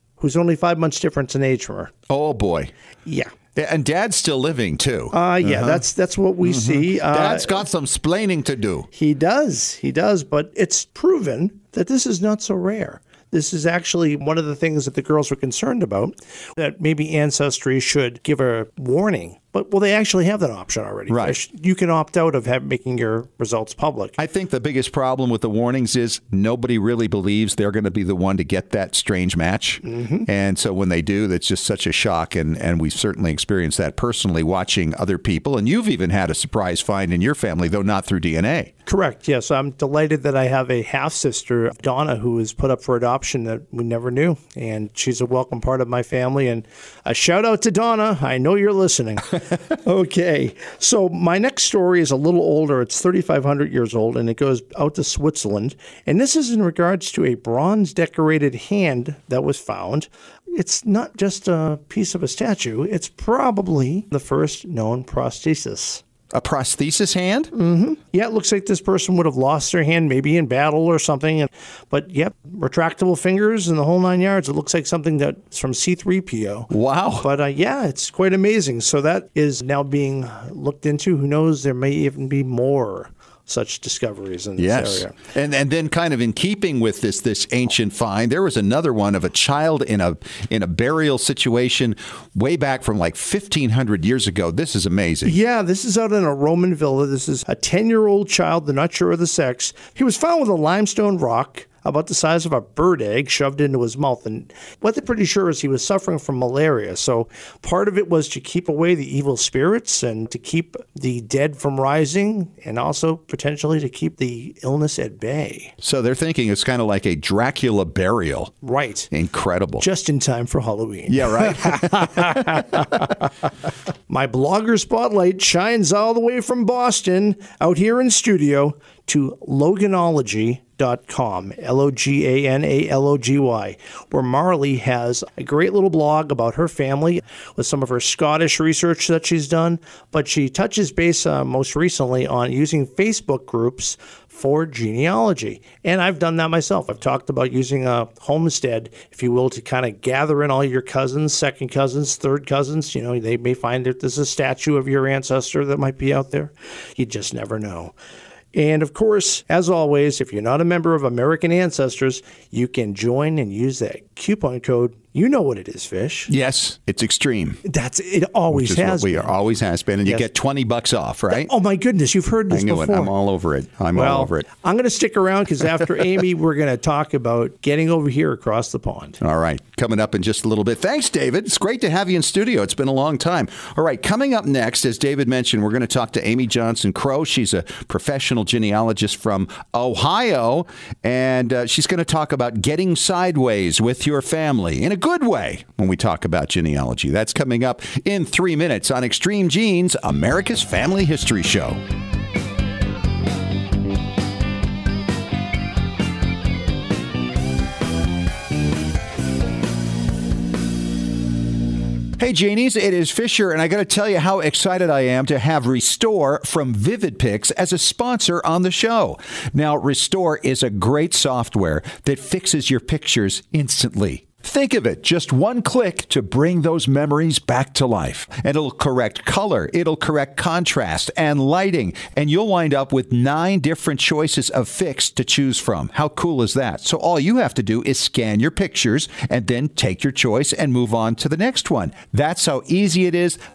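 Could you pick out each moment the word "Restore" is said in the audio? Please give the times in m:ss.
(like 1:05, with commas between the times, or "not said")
3:35, 3:39.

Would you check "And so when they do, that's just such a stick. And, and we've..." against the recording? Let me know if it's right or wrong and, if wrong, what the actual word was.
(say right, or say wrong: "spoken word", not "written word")
wrong: "shock", not "stick".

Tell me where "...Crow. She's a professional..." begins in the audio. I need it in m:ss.
3:06.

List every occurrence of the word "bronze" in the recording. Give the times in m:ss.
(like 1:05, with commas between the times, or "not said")
0:57.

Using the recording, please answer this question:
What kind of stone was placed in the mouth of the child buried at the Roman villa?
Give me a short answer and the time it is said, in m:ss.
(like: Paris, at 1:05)
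Limestone, at 1:40.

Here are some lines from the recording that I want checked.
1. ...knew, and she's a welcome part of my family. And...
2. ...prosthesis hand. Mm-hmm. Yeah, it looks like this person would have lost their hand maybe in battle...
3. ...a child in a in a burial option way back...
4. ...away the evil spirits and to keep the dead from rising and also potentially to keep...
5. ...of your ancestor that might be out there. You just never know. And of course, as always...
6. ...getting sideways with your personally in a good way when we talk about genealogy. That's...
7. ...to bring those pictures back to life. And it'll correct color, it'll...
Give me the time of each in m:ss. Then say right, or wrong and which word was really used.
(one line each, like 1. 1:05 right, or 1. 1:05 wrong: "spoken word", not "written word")
1. 0:44 right
2. 1:06 right
3. 1:29 wrong: "situation", not "option"
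4. 1:48 right
5. 2:34 right
6. 3:12 wrong: "family", not "personally"
7. 3:46 wrong: "memories", not "pictures".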